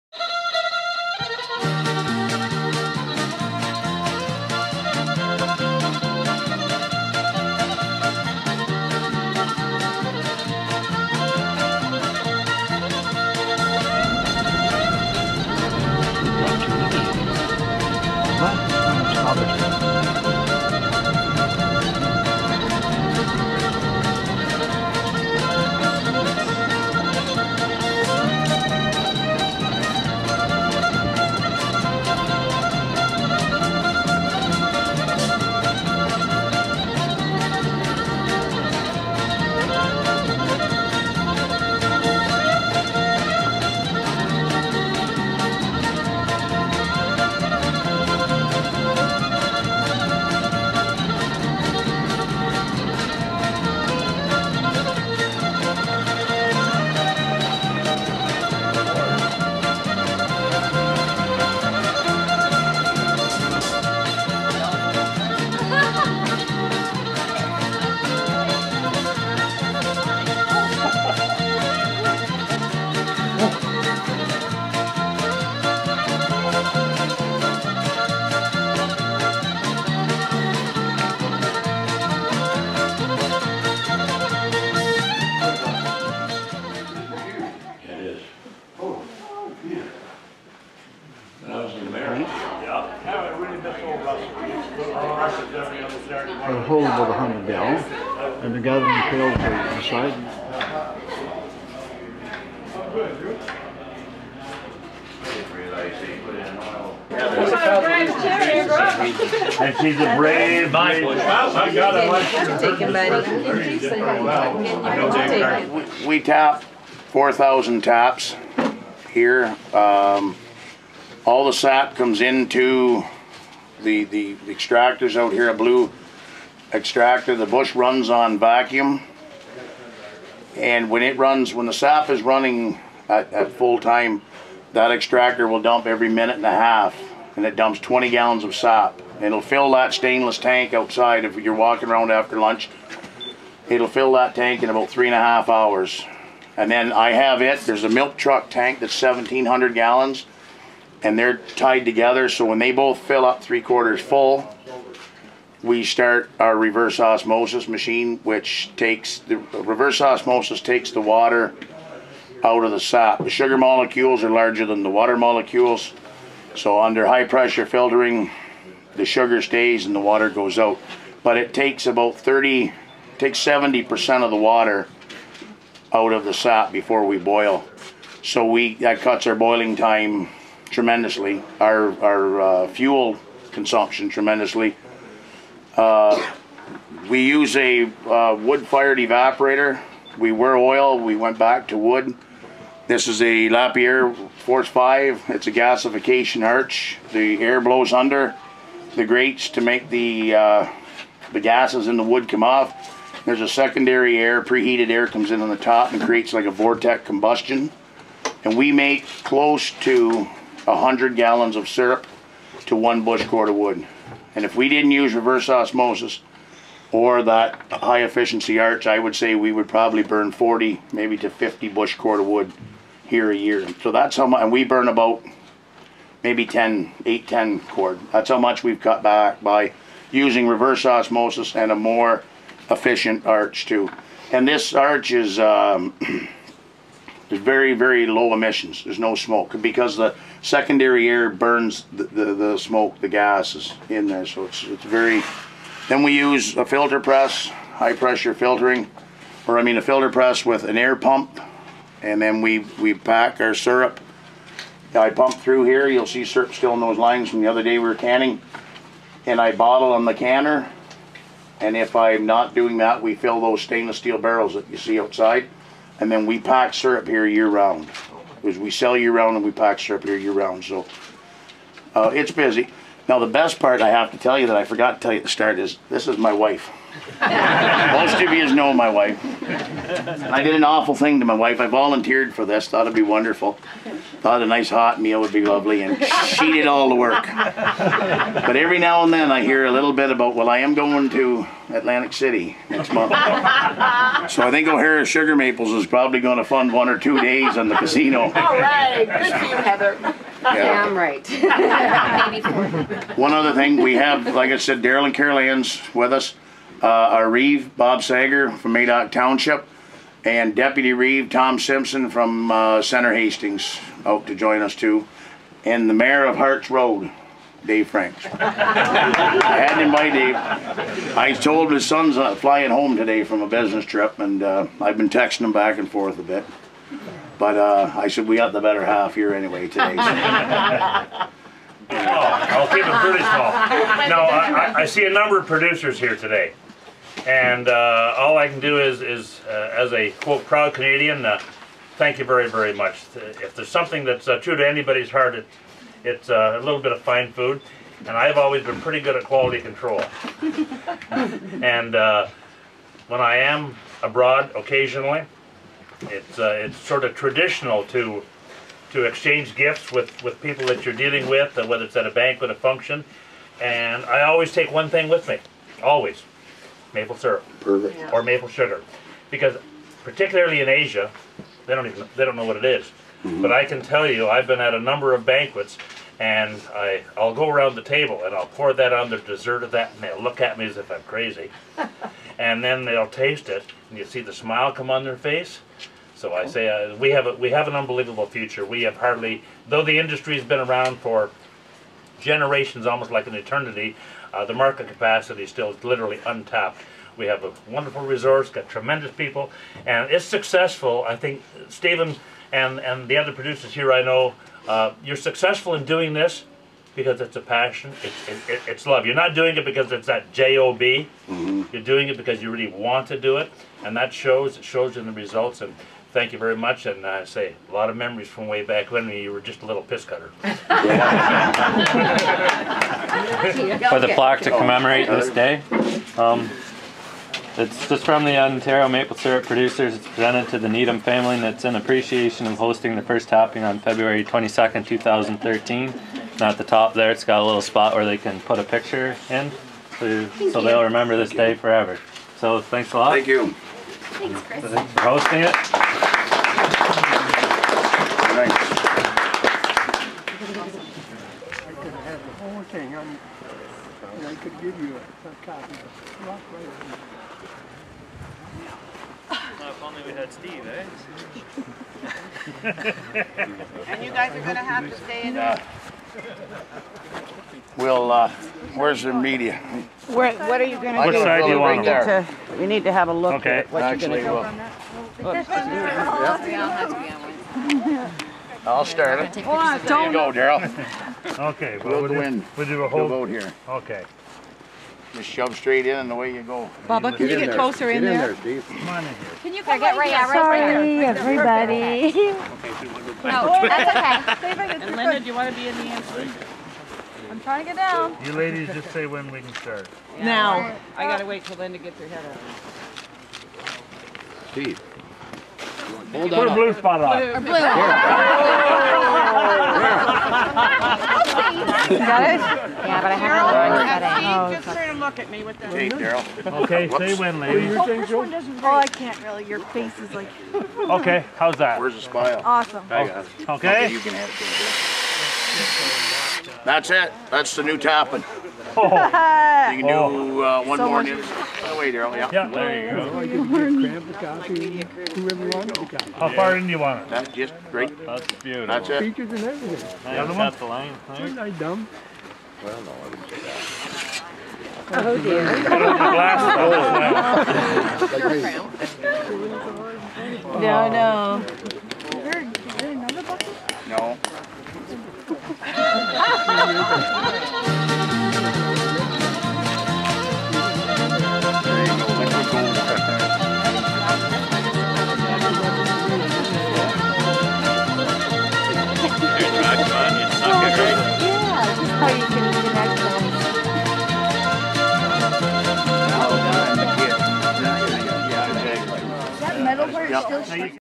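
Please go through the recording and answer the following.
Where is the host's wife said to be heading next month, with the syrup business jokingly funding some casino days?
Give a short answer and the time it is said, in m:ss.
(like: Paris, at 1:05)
Atlantic City, at 4:51.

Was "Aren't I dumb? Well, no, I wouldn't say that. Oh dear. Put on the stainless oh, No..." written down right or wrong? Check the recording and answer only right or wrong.
wrong.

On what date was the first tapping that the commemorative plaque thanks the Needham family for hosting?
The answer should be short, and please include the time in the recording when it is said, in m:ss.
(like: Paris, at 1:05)
February 22, 2013, at 7:13.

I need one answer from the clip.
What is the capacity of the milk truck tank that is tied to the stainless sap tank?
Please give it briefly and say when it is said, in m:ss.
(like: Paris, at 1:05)
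1,700 gallons, at 2:29.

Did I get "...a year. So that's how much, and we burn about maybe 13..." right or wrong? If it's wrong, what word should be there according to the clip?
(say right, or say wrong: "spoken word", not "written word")
wrong: "10", not "13".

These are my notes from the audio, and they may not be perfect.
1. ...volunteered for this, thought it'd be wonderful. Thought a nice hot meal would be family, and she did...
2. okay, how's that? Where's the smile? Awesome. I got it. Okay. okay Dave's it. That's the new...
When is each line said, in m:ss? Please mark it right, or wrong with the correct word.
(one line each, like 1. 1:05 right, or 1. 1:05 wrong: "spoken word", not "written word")
1. 4:41 wrong: "lovely", not "family"
2. 8:40 wrong: "That", not "Dave".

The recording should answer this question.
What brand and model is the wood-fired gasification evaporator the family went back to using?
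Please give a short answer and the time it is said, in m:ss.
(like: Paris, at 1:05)
Lapierre Force 5, at 3:13.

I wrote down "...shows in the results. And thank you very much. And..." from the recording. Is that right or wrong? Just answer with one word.
right.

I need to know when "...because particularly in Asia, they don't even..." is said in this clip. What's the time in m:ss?
6:09.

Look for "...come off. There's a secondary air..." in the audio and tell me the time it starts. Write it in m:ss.
3:22.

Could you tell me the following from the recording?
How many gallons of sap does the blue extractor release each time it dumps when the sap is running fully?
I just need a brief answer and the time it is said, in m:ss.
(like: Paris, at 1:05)
20 gallons, at 2:17.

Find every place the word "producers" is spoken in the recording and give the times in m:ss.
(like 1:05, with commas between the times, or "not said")
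5:35, 6:43, 7:09.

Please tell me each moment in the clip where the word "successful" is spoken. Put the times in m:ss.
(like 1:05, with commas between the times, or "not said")
6:40, 6:45.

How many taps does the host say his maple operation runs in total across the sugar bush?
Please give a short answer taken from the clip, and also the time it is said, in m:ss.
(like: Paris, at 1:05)
4,000, at 1:57.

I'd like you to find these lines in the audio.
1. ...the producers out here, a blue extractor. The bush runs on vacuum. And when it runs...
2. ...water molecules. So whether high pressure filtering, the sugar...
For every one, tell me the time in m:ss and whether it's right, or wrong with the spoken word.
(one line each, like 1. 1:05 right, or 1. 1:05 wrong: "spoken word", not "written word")
1. 2:04 wrong: "extractors", not "producers"
2. 2:44 wrong: "under", not "whether".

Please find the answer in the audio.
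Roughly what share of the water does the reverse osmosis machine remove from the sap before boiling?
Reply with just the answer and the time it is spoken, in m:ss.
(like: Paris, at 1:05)
70%, at 2:53.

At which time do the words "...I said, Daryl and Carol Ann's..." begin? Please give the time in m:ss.
5:04.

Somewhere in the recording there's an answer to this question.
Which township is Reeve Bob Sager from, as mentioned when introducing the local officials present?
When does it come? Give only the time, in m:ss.
5:08.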